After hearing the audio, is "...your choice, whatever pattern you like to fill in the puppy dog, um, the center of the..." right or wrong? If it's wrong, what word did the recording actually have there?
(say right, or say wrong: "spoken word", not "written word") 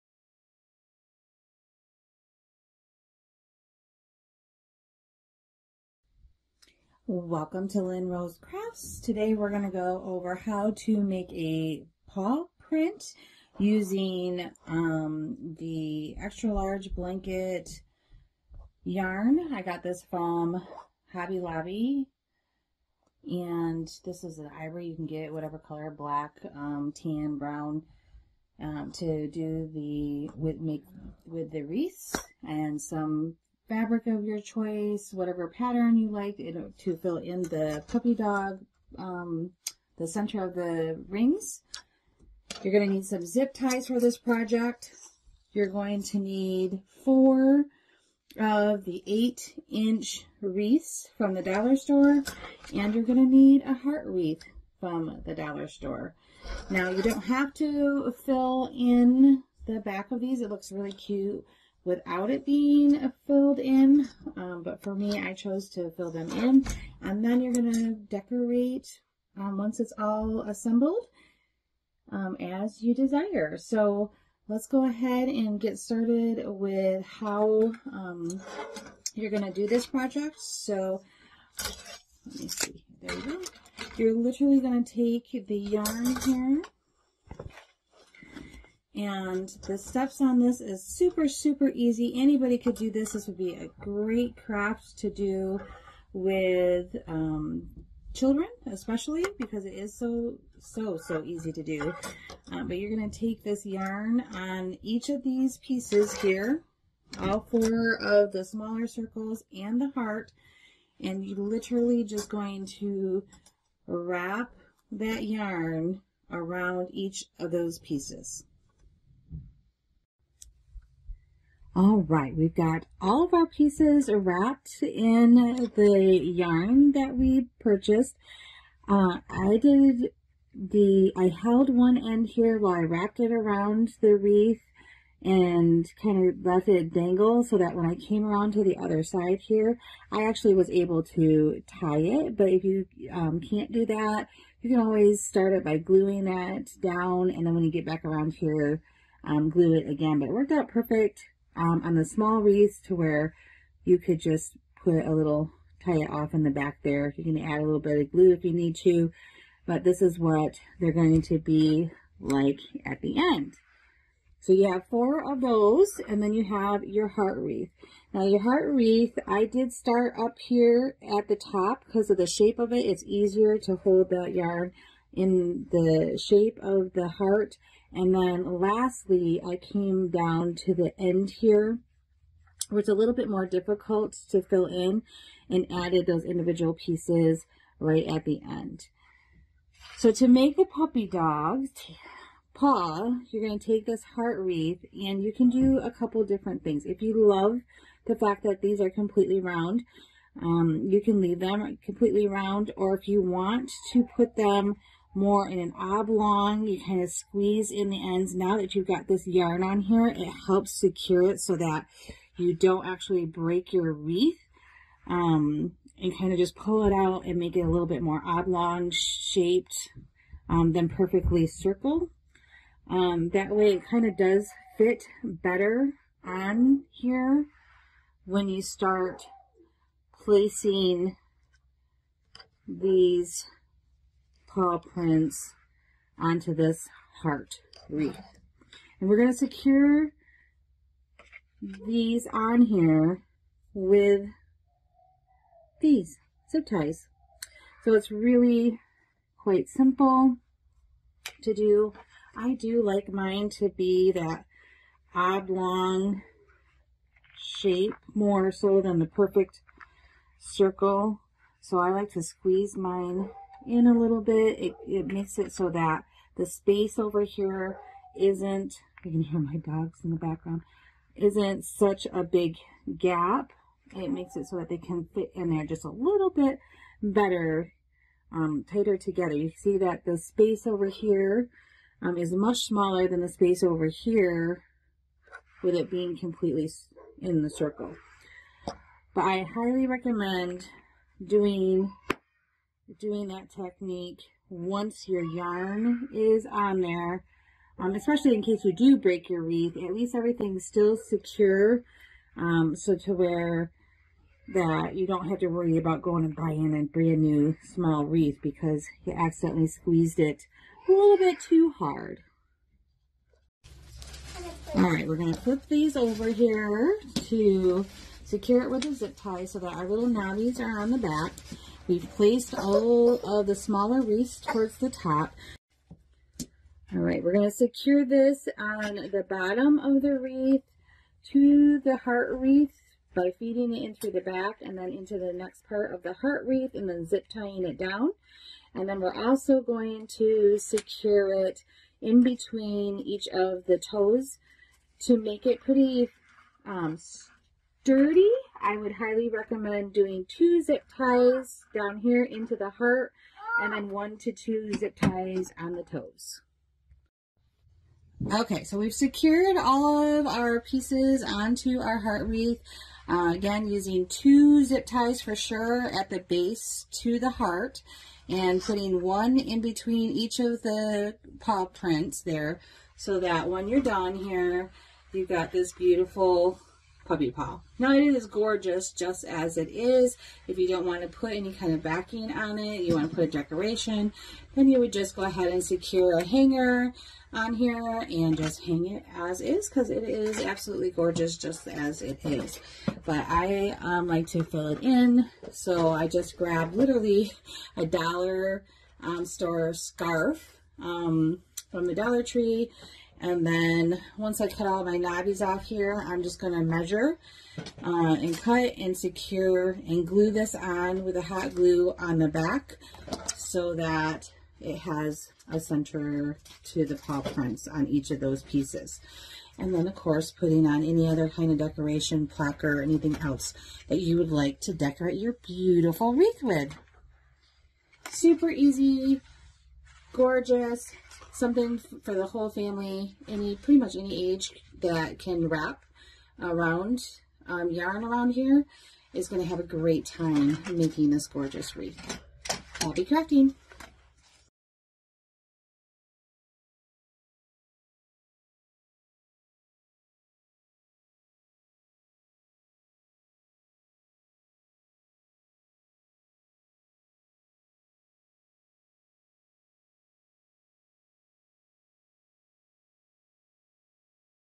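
right.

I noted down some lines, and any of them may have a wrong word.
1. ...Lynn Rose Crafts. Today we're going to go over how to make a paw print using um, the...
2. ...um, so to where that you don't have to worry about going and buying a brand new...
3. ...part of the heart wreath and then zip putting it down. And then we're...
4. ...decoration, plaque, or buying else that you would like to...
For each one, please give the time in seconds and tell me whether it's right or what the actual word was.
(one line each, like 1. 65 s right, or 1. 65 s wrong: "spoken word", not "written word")
1. 7 s right
2. 302 s right
3. 335 s wrong: "tying", not "putting"
4. 421 s wrong: "anything", not "buying".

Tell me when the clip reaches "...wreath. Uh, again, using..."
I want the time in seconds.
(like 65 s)
362 s.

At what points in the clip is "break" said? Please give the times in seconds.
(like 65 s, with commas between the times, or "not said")
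213 s, 298 s.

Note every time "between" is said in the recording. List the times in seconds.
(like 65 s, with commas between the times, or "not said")
342 s, 369 s.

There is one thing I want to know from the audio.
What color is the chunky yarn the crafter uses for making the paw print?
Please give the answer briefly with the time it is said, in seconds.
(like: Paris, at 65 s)
Ivory, at 24 s.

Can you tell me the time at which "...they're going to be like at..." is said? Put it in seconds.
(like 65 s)
160 s.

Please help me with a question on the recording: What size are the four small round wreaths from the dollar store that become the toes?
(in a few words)
8 inch.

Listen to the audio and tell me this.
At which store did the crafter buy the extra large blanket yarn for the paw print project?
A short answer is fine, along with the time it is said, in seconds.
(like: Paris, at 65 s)
Hobby Lobby, at 21 s.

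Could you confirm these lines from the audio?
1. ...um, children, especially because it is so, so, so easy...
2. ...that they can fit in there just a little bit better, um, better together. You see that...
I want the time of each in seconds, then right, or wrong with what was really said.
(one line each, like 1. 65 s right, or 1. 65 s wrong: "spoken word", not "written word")
1. 97 s right
2. 274 s wrong: "tighter", not "better".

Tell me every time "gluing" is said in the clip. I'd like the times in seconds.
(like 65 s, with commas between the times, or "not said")
145 s.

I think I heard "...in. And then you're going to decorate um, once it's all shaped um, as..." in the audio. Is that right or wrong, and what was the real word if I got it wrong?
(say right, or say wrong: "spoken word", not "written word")
wrong: "assembled", not "shaped".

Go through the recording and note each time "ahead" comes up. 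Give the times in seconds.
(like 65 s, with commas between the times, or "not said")
74 s, 385 s.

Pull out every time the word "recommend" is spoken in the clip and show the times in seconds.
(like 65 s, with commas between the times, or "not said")
289 s, 349 s.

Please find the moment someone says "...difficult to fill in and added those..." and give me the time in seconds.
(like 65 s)
183 s.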